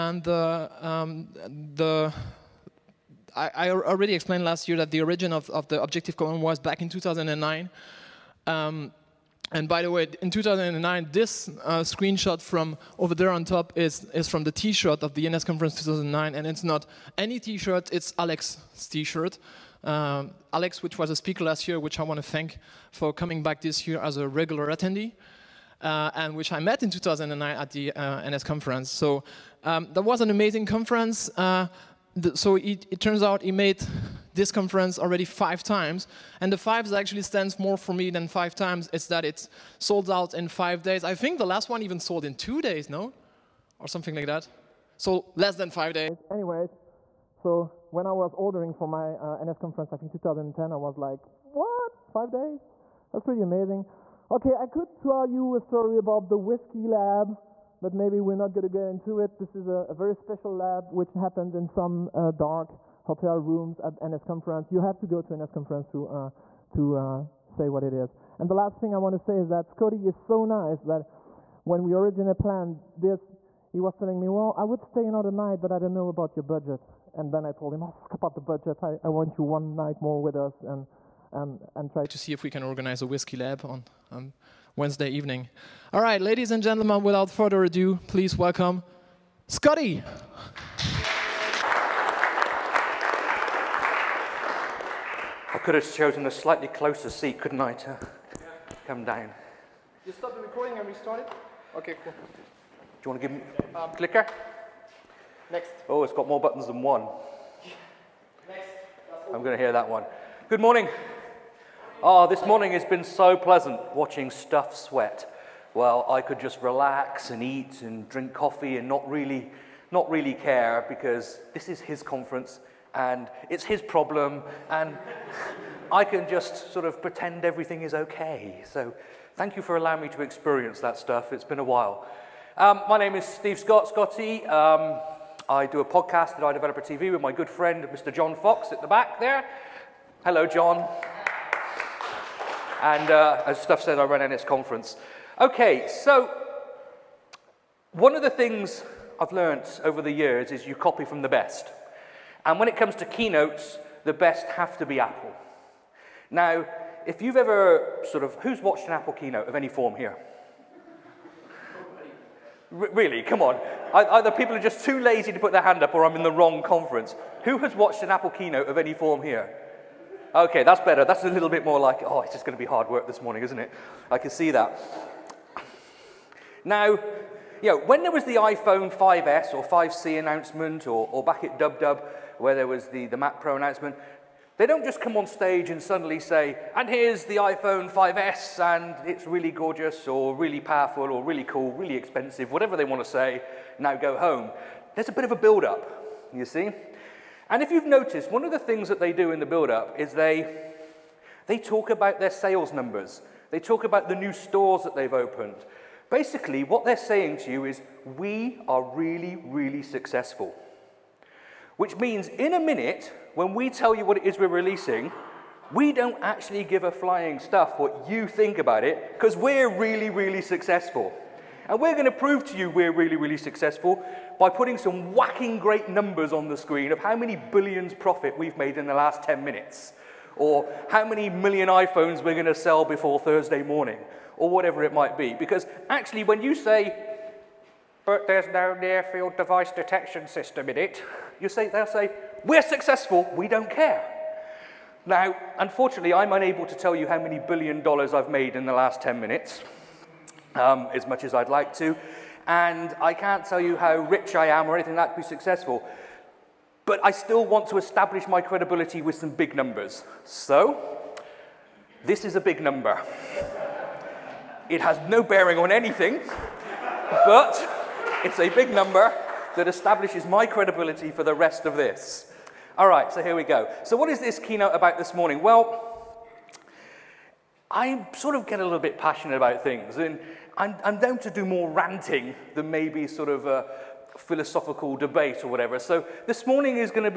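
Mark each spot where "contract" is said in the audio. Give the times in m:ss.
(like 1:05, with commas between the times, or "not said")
not said.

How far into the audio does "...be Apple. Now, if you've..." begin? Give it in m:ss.
2:34.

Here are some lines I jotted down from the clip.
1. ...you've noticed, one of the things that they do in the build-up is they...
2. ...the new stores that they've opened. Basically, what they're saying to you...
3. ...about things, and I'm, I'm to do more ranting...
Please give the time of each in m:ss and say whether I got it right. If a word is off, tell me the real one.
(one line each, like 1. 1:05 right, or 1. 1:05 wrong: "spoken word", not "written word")
1. 3:17 right
2. 3:24 right
3. 4:39 right.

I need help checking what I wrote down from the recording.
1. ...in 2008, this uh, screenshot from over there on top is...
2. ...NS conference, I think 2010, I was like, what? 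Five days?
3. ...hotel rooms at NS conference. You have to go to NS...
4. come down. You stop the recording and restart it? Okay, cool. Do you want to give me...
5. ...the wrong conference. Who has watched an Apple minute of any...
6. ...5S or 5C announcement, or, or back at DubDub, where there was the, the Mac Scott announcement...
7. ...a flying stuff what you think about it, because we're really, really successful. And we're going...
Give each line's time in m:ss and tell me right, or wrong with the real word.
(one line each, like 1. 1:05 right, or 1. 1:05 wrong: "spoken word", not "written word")
1. 0:10 wrong: "2009", not "2008"
2. 0:49 right
3. 1:03 right
4. 1:38 right
5. 2:46 wrong: "keynote", not "minute"
6. 2:58 wrong: "Pro", not "Scott"
7. 3:36 right.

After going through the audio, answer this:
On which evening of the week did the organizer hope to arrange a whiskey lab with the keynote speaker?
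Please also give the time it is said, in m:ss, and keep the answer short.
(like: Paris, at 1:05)
Wednesday, at 1:24.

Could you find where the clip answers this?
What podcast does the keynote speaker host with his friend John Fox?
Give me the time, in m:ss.
2:16.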